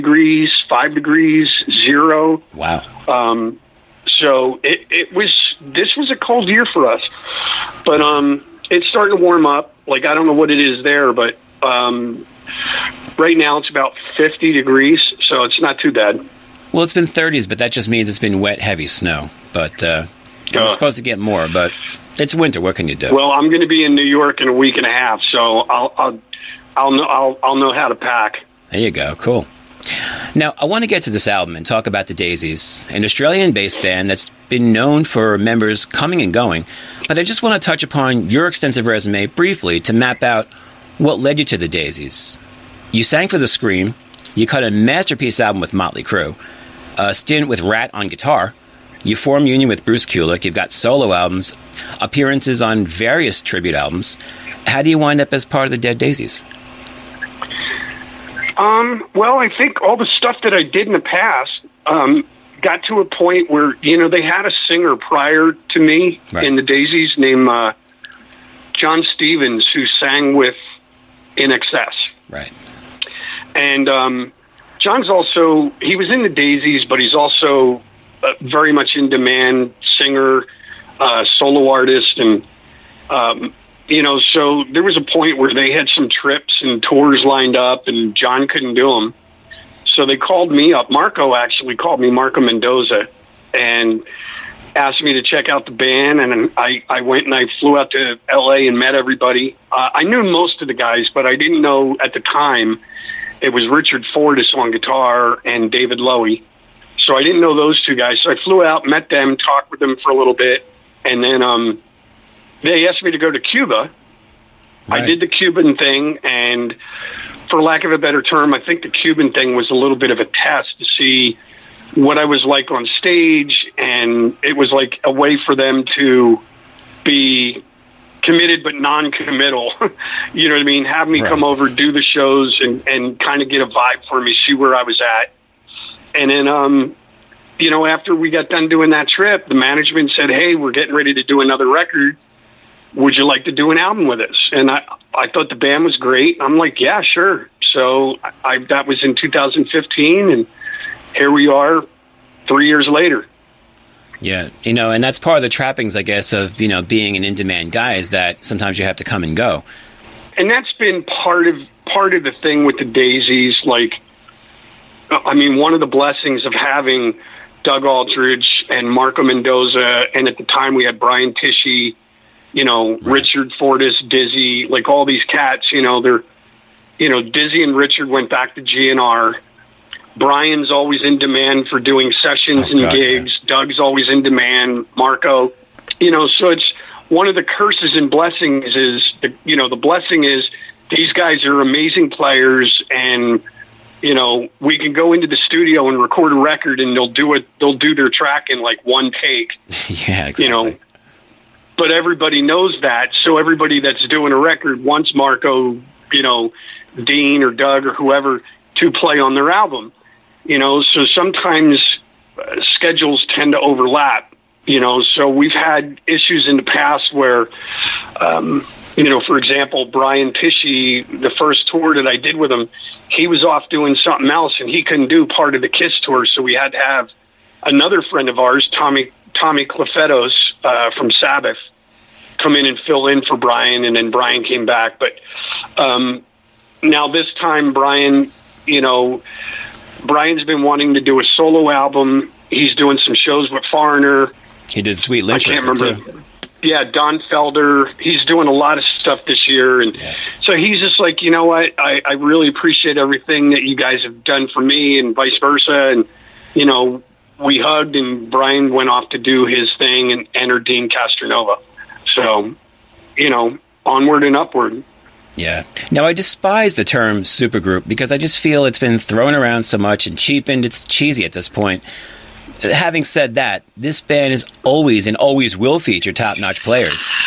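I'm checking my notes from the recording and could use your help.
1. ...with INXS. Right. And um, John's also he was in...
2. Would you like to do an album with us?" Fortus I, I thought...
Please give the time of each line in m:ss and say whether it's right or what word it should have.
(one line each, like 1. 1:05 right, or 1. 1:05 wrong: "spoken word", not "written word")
1. 1:10 right
2. 2:22 wrong: "And", not "Fortus".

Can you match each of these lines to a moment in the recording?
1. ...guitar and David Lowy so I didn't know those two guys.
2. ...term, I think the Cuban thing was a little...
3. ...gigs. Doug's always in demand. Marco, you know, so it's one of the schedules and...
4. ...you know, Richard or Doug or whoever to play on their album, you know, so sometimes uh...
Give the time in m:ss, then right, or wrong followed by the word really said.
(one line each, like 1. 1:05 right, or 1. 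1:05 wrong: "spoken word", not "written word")
1. 1:44 right
2. 1:58 right
3. 3:02 wrong: "curses", not "schedules"
4. 3:26 wrong: "Dean", not "Richard".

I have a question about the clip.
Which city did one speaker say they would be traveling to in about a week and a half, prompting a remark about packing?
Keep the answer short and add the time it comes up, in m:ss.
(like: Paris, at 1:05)
New York, at 0:23.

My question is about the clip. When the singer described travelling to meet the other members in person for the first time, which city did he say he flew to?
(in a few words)
LA.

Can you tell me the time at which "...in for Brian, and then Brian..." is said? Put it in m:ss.
3:53.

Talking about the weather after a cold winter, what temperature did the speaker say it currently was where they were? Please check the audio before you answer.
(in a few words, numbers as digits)
50 degrees.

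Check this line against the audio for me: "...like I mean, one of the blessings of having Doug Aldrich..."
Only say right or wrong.
right.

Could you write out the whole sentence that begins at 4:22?
So, you know, onward and upward.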